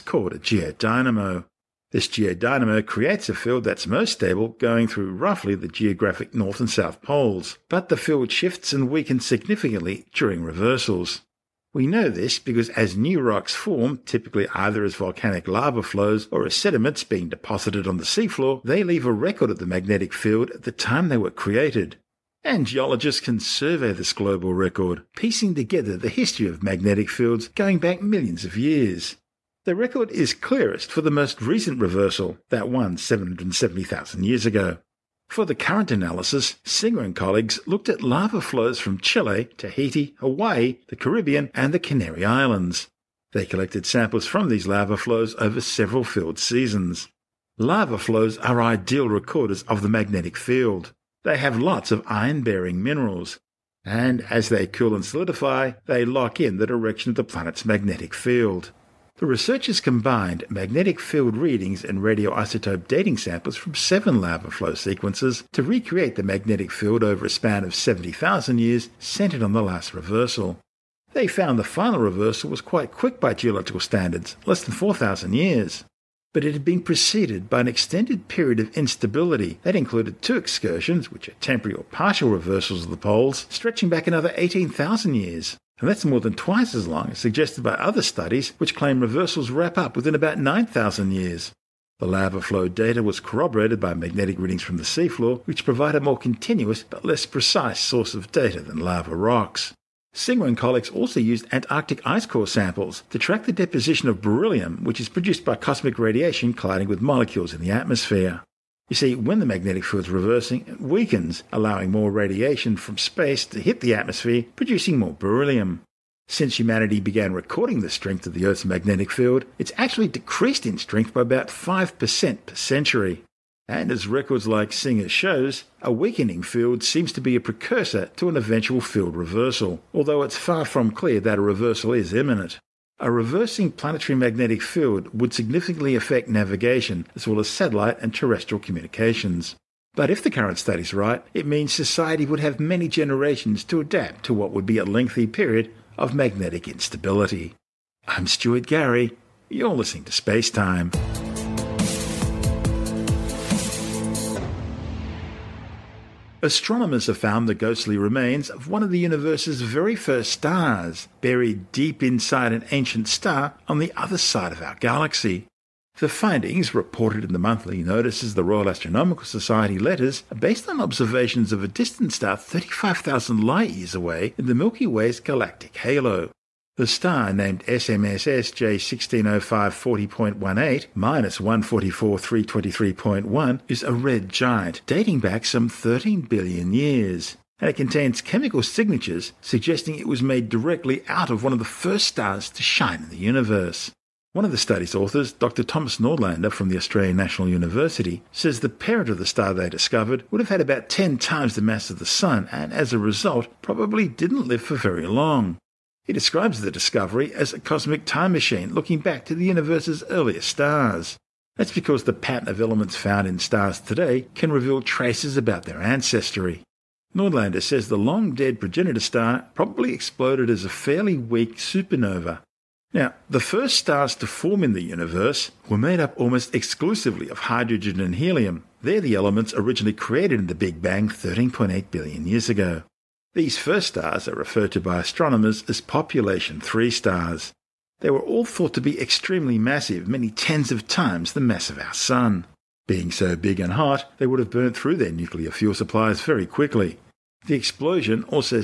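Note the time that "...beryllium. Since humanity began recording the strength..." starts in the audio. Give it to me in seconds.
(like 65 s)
115 s.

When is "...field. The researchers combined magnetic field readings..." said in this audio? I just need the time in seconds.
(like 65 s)
58 s.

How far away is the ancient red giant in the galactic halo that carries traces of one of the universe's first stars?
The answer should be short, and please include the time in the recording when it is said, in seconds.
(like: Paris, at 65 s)
35,000 light years, at 172 s.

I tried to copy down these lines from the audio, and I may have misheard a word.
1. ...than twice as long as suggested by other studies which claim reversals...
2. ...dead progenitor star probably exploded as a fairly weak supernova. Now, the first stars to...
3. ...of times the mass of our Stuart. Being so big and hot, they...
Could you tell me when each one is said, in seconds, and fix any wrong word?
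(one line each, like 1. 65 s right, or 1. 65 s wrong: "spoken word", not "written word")
1. 86 s right
2. 218 s right
3. 240 s wrong: "Sun", not "Stuart".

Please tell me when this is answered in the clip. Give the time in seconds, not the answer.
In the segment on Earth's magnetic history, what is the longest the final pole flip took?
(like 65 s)
74 s.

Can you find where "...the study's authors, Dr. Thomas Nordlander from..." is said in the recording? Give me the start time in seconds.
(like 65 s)
194 s.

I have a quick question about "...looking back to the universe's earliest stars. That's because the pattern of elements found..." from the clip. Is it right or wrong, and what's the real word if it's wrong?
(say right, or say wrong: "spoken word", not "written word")
right.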